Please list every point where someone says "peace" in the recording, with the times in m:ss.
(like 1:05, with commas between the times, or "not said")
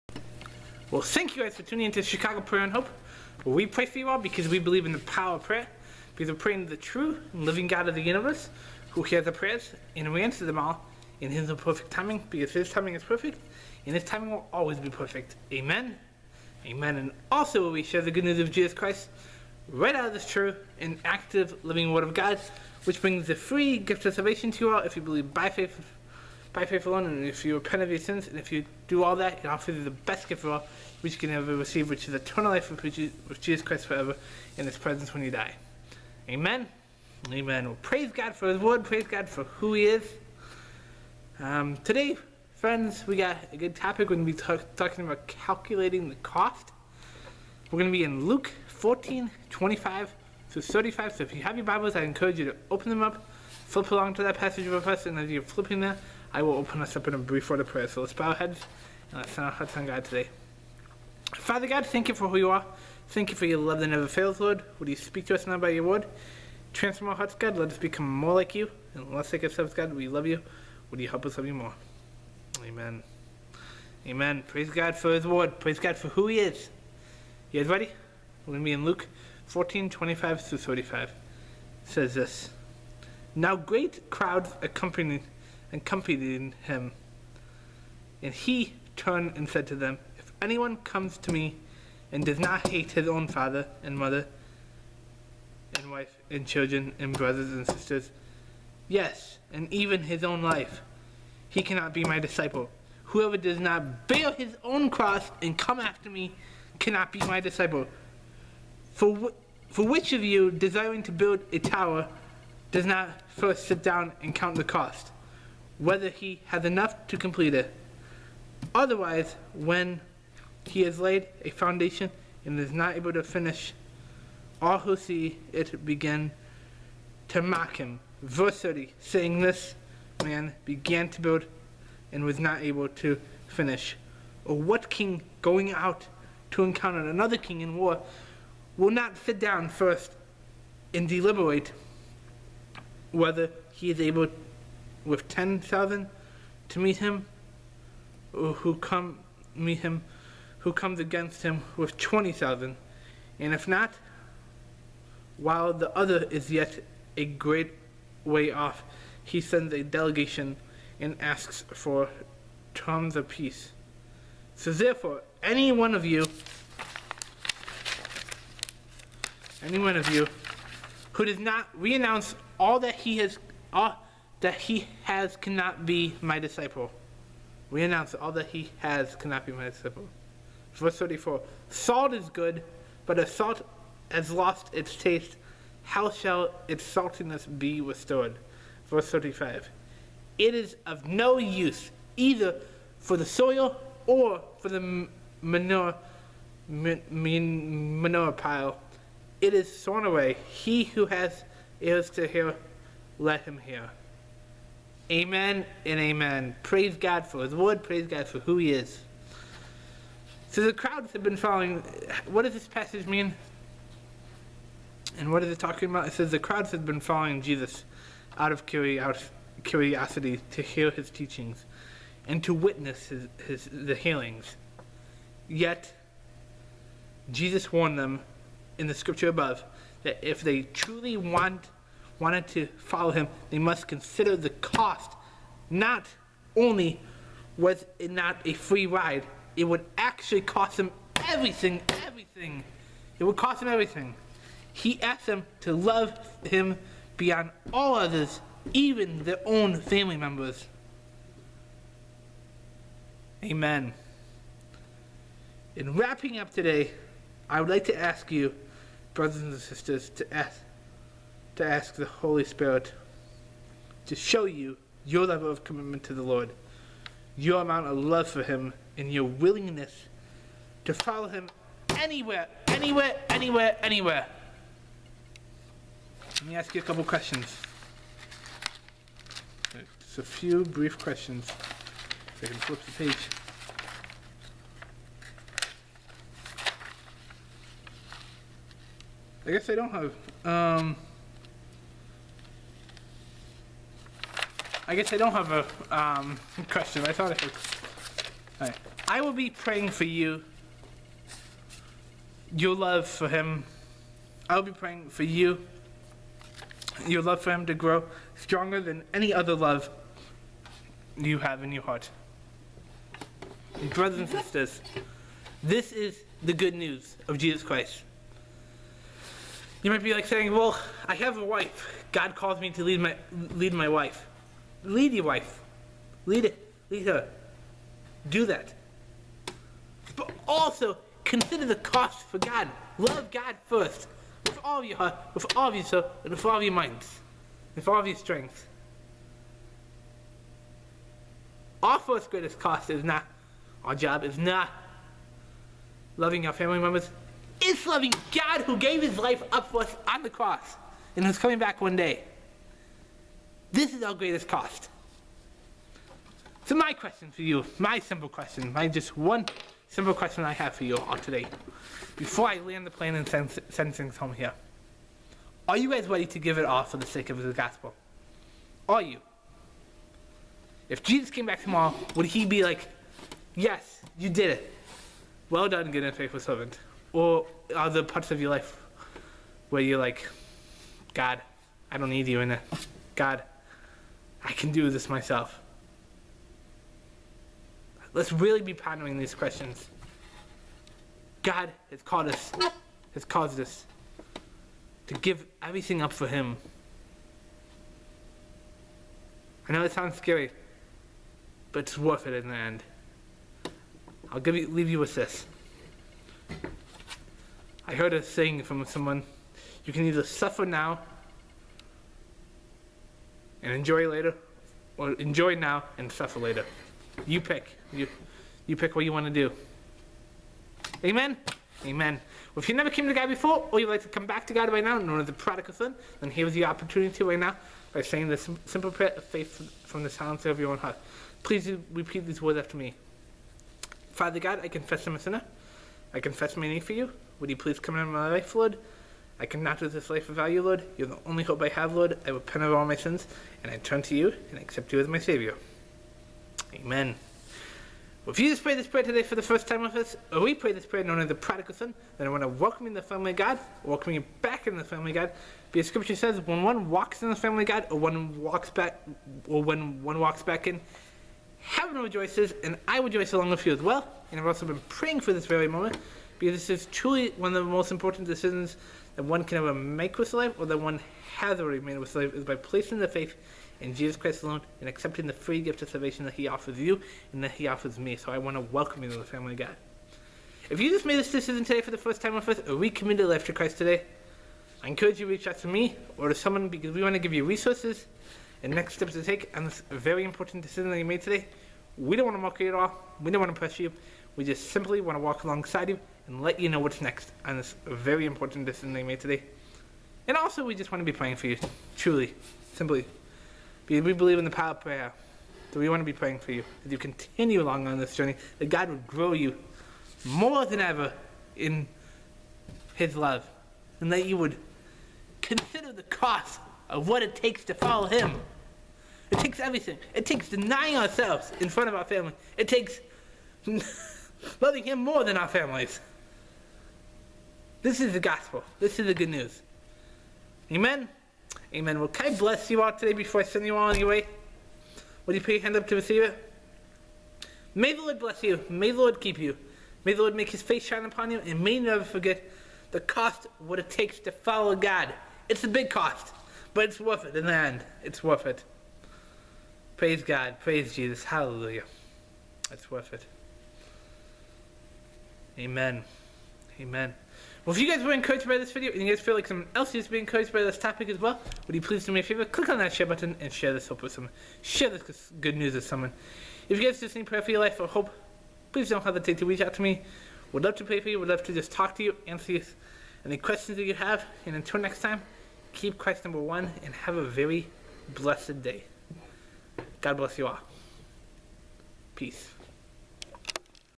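2:43, 9:42.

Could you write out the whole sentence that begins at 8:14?
We just simply want to walk alongside you and let you know what's next on this very important decision they made today.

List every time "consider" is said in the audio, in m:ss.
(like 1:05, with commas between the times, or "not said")
3:53, 5:31, 8:35.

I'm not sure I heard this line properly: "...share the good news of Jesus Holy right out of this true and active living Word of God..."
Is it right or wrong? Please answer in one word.
wrong.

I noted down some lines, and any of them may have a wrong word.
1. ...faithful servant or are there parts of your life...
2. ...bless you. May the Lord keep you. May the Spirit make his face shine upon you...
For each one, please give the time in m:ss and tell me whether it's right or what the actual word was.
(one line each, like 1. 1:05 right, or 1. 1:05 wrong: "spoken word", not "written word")
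1. 6:16 right
2. 8:58 wrong: "Lord", not "Spirit".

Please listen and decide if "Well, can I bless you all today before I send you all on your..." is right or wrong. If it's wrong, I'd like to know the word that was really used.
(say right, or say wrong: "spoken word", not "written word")
right.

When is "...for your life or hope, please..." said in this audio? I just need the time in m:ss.
9:27.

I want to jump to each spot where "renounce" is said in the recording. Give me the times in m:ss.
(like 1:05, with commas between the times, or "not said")
2:51, 2:57.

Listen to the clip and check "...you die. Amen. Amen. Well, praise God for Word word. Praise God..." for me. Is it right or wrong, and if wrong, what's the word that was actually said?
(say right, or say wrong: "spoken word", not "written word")
wrong: "His", not "Word".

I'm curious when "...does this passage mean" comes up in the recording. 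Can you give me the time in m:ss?
3:32.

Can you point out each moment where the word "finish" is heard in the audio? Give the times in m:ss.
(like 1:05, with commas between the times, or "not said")
2:03, 2:13.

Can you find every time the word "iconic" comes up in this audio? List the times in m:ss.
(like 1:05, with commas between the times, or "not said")
not said.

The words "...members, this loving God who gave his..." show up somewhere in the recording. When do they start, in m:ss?
5:46.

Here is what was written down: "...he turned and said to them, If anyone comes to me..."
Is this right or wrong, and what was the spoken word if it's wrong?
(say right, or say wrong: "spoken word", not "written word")
right.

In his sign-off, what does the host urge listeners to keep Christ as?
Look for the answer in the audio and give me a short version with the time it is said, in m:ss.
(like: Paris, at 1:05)
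Number one, at 9:36.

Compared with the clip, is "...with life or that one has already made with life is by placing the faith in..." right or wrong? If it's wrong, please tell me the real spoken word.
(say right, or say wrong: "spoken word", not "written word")
right.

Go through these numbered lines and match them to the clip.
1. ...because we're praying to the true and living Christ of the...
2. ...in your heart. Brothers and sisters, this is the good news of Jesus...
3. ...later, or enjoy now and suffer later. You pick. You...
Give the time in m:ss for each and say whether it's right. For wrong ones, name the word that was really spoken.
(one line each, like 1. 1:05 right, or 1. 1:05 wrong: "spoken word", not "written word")
1. 0:06 wrong: "God", not "Christ"
2. 5:11 right
3. 6:54 right.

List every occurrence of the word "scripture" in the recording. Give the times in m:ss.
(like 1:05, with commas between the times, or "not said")
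3:48, 7:35.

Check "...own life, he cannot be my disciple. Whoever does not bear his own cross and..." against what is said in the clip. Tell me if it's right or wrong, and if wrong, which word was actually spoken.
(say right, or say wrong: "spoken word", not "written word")
right.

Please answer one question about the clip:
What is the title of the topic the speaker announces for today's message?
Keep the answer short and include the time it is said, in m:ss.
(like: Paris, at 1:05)
Calculating the cost, at 0:45.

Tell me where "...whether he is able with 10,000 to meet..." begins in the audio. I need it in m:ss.
2:23.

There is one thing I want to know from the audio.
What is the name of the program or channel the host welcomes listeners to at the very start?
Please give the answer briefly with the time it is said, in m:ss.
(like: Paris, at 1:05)
Chicago Prayer and Hope, at 0:02.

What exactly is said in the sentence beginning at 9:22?
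Click on that share button and share this hope with someone.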